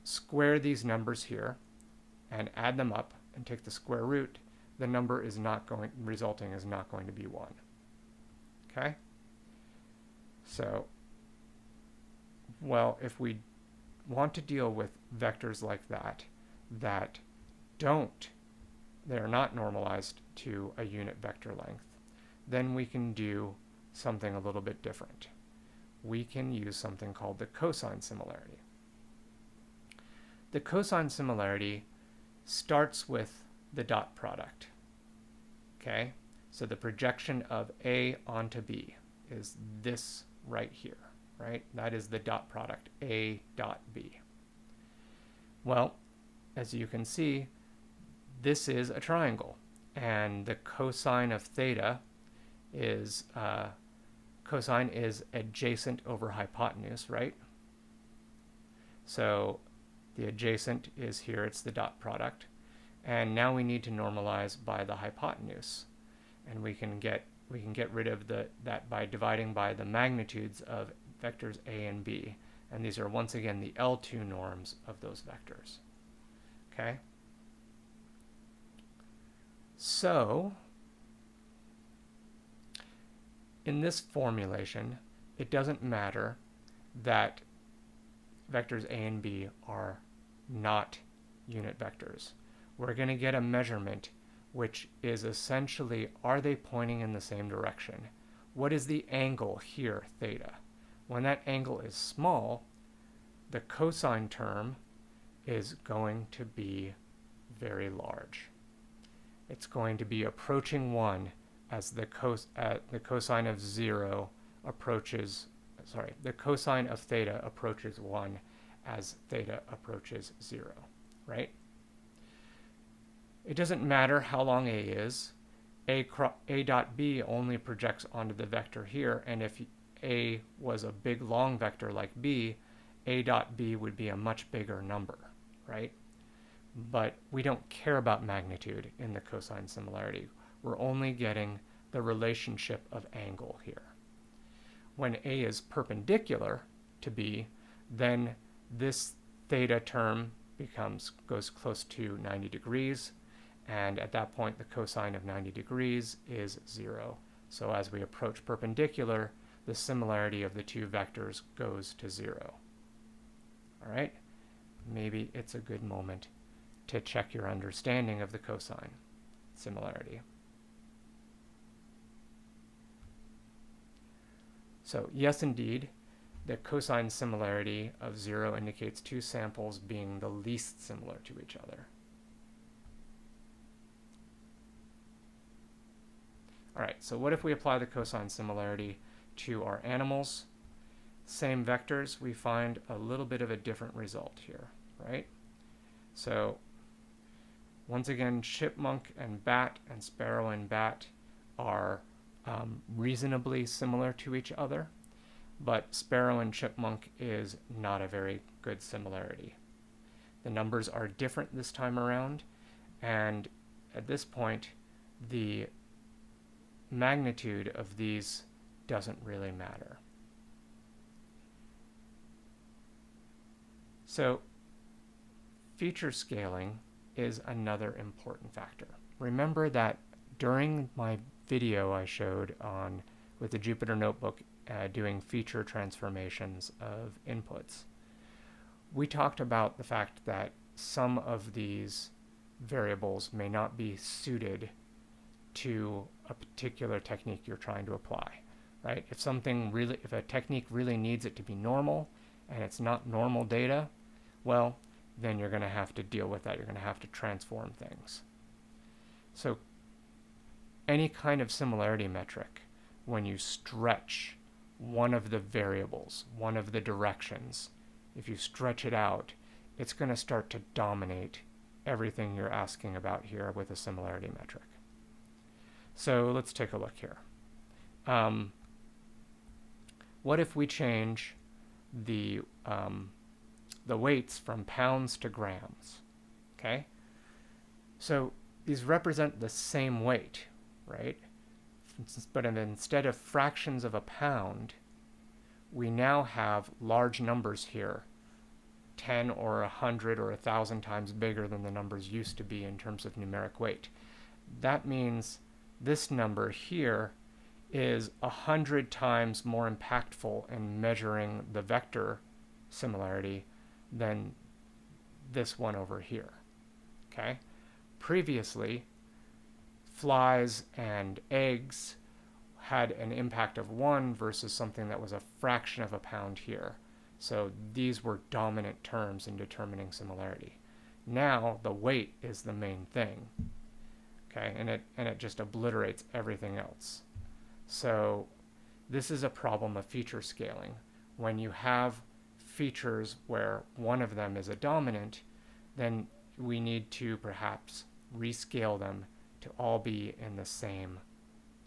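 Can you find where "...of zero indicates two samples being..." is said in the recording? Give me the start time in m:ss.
2:58.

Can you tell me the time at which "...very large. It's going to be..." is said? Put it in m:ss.
1:47.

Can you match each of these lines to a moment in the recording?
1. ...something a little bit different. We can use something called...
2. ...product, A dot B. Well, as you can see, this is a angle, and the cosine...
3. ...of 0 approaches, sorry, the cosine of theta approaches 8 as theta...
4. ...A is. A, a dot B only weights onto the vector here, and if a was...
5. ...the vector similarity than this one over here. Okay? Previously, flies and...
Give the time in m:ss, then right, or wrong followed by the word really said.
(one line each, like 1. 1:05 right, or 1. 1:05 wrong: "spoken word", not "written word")
1. 0:23 right
2. 0:42 wrong: "triangle", not "angle"
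3. 1:53 wrong: "1", not "8"
4. 2:04 wrong: "projects", not "weights"
5. 5:11 right.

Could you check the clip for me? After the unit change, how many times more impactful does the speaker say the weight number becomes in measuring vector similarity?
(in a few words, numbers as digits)
100.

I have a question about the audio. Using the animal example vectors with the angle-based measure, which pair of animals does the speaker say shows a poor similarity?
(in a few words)
sparrow and chipmunk.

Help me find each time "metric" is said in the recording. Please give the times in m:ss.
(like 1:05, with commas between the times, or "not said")
4:22, 4:34.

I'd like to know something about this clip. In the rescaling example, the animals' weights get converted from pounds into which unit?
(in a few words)
grams.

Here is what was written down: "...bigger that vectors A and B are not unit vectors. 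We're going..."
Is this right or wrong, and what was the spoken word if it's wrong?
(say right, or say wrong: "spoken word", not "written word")
wrong: "matter", not "bigger".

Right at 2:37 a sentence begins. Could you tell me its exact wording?
So as we approach perpendicular, the similarity of the two vectors goes to zero.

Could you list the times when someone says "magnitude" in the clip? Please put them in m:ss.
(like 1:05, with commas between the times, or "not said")
1:09, 2:18, 3:36.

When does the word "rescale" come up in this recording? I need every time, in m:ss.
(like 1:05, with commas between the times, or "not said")
5:48.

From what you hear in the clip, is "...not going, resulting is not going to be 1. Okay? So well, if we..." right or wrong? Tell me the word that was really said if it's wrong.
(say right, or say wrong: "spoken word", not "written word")
right.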